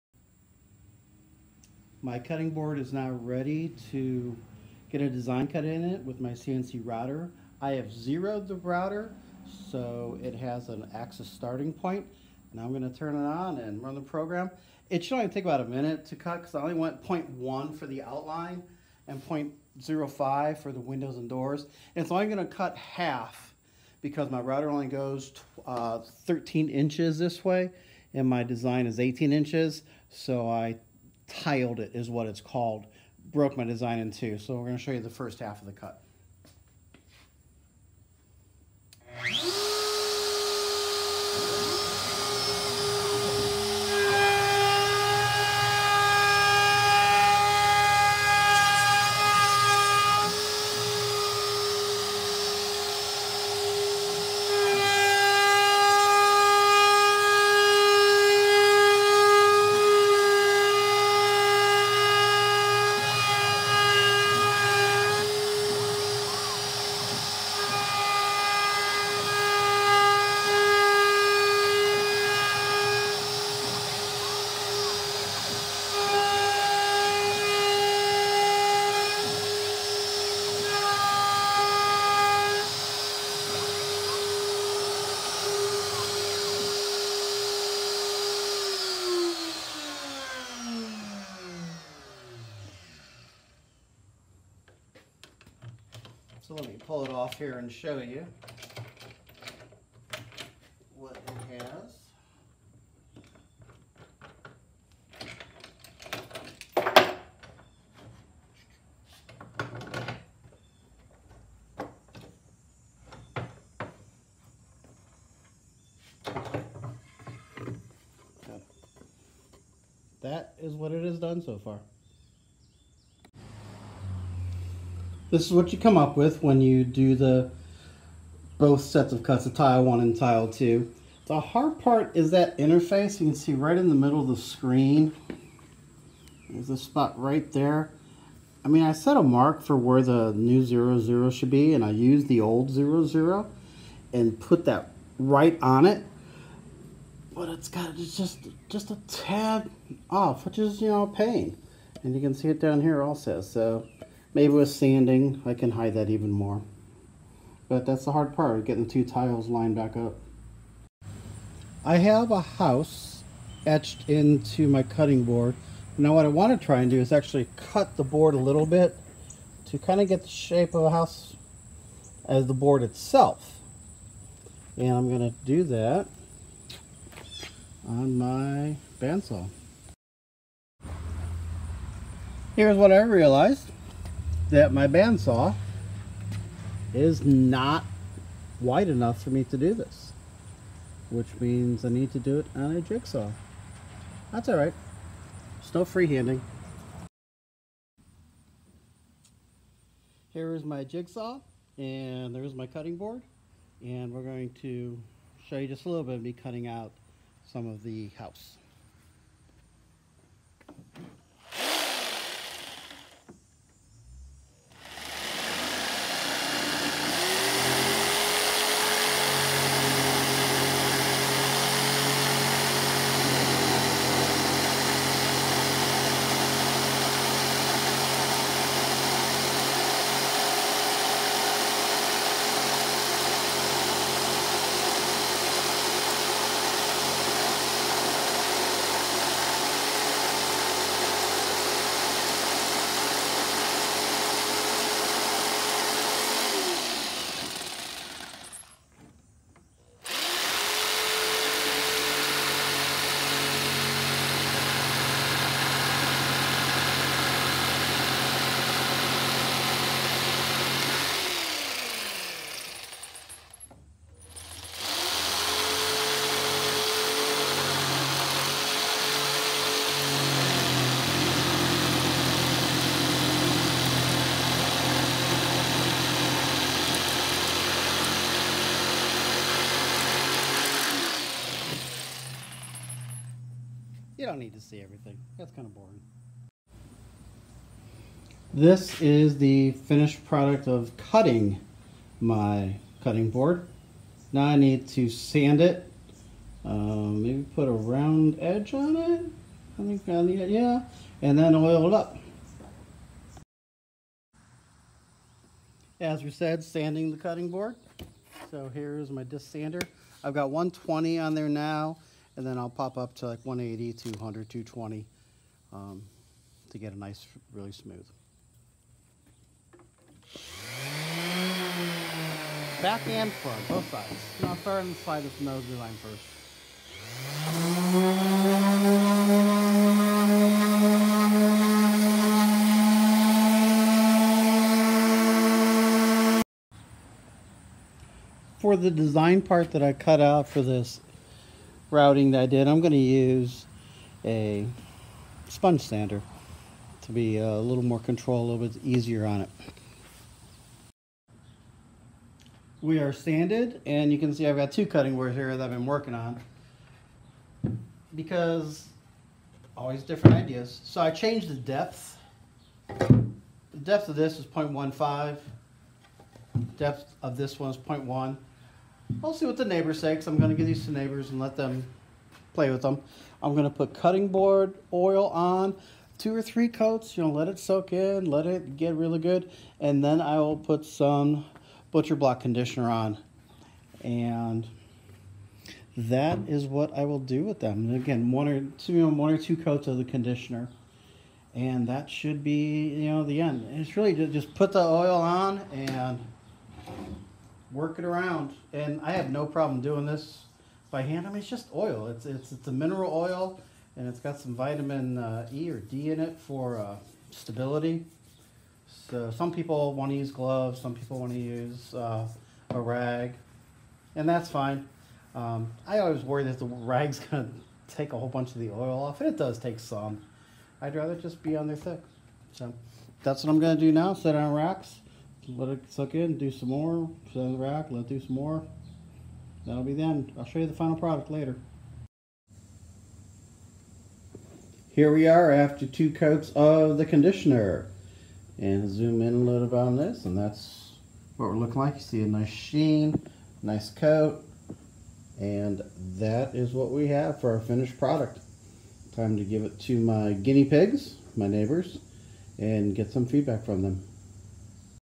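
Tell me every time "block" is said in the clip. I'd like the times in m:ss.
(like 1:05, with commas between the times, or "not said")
6:22.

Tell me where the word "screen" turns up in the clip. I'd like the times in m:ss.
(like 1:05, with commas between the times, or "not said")
2:14.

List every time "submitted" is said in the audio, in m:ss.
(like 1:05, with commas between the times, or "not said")
not said.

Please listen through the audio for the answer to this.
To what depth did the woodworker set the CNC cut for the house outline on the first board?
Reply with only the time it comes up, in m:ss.
0:17.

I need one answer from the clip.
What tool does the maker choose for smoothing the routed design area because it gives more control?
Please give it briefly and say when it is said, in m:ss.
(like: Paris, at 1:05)
sponge sander, at 5:45.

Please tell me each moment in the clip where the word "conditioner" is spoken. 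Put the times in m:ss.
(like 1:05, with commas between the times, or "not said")
6:22, 6:30, 7:17.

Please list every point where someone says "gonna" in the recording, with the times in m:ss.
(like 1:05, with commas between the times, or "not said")
6:57, 7:03.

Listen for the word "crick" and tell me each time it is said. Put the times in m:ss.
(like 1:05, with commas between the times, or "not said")
not said.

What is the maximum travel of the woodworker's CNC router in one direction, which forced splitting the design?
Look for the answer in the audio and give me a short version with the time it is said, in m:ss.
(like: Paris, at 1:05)
13 inches, at 0:25.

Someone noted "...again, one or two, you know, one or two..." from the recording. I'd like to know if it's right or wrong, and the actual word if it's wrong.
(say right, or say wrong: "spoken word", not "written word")
right.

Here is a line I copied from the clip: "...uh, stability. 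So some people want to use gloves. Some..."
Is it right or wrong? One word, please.
right.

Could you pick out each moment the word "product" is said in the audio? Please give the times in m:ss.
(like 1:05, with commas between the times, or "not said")
4:50, 7:10, 7:27.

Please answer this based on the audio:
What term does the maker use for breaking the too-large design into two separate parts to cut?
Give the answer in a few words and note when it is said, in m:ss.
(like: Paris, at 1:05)
tiled, at 0:31.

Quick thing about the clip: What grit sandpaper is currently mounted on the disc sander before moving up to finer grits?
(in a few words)
120.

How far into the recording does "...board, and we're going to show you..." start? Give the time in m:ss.
3:22.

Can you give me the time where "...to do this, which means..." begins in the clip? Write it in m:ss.
3:09.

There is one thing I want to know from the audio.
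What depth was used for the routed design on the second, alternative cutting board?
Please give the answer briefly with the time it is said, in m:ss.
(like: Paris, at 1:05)
0.15, at 6:04.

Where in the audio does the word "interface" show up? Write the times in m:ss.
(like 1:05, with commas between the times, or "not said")
2:12.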